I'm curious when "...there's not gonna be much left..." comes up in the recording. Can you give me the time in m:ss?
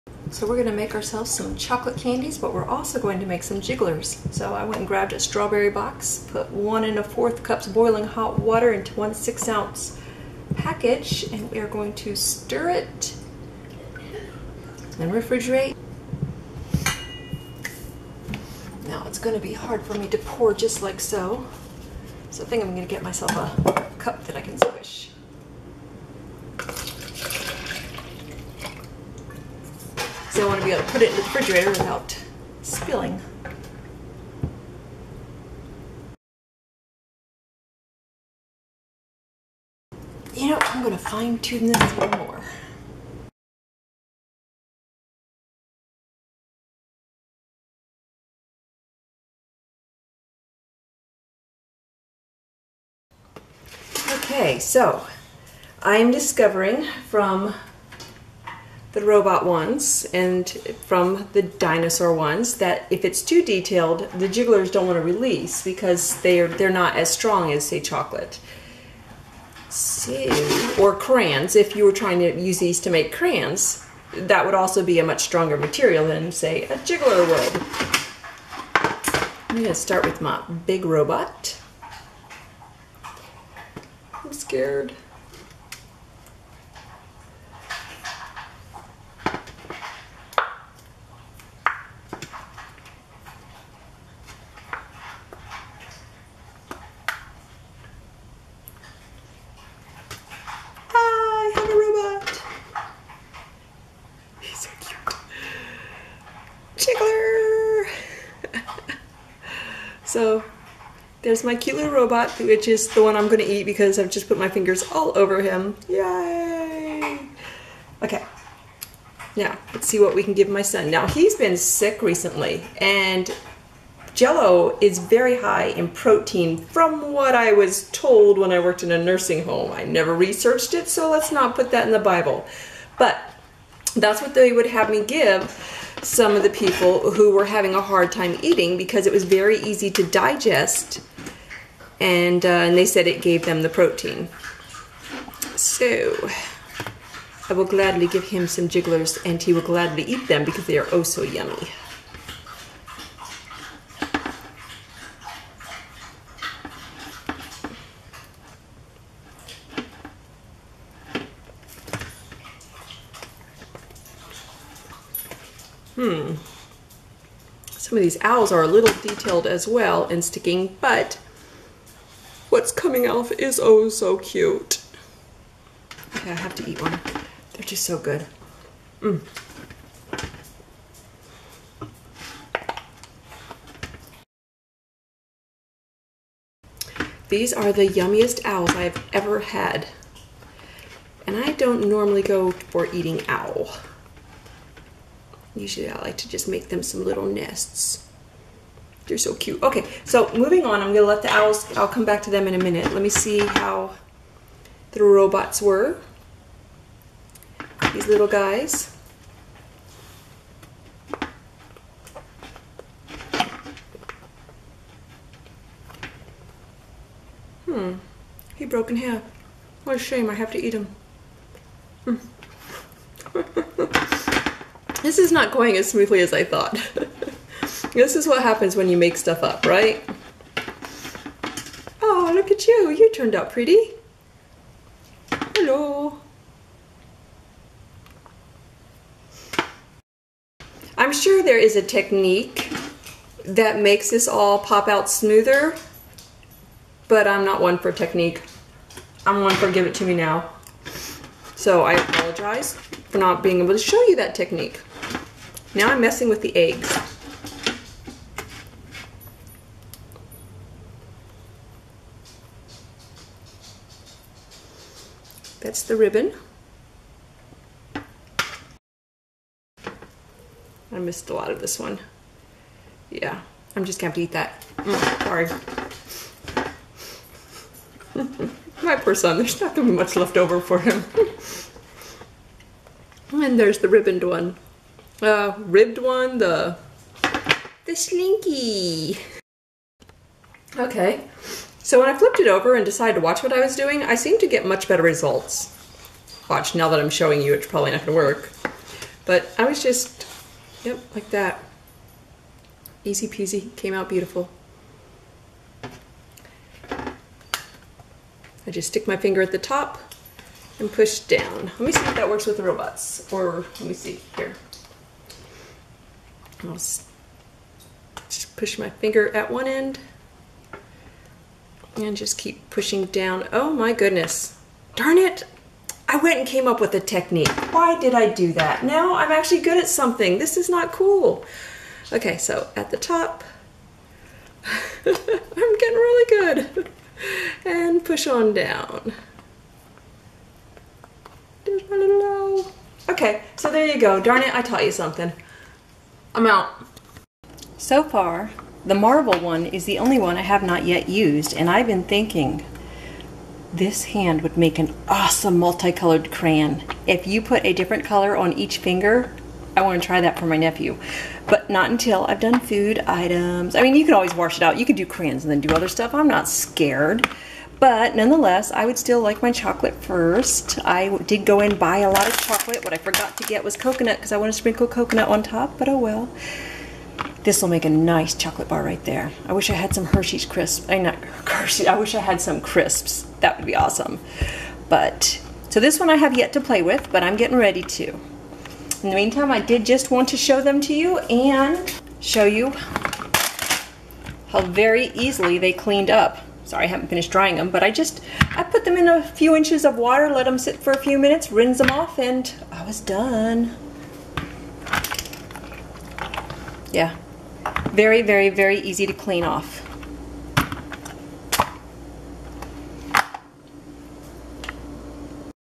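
4:39.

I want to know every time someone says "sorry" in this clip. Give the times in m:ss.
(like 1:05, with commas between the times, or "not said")
4:35, 6:36.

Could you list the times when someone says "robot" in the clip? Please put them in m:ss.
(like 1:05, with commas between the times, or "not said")
0:59, 1:20, 1:51, 3:25, 5:12.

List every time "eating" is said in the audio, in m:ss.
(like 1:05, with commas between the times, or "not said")
2:18, 3:12.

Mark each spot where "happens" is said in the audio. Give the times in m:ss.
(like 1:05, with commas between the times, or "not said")
3:48.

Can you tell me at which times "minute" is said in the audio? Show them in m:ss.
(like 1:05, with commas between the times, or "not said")
3:22, 6:41.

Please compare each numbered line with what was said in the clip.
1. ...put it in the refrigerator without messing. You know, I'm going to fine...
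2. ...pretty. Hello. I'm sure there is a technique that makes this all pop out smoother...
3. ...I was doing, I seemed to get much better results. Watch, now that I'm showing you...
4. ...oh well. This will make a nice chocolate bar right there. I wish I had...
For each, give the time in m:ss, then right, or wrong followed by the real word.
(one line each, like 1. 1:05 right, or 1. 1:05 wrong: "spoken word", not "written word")
1. 0:30 wrong: "spilling", not "messing"
2. 3:53 right
3. 4:53 right
4. 6:15 right.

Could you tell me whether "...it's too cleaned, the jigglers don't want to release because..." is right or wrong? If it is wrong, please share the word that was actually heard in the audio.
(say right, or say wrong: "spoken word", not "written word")
wrong: "detailed", not "cleaned".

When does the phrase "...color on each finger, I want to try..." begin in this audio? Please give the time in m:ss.
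5:58.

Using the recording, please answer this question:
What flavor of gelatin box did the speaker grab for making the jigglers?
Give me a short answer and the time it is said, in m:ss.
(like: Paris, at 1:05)
Strawberry, at 0:05.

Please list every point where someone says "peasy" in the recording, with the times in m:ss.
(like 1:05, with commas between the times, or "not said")
5:03.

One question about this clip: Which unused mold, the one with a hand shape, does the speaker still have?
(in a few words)
Marvel.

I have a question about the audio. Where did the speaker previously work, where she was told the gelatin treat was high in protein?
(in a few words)
Nursing home.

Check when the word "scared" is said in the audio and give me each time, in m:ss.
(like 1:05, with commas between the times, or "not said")
1:24, 6:06.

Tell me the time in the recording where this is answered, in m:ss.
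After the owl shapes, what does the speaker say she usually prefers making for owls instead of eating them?
3:17.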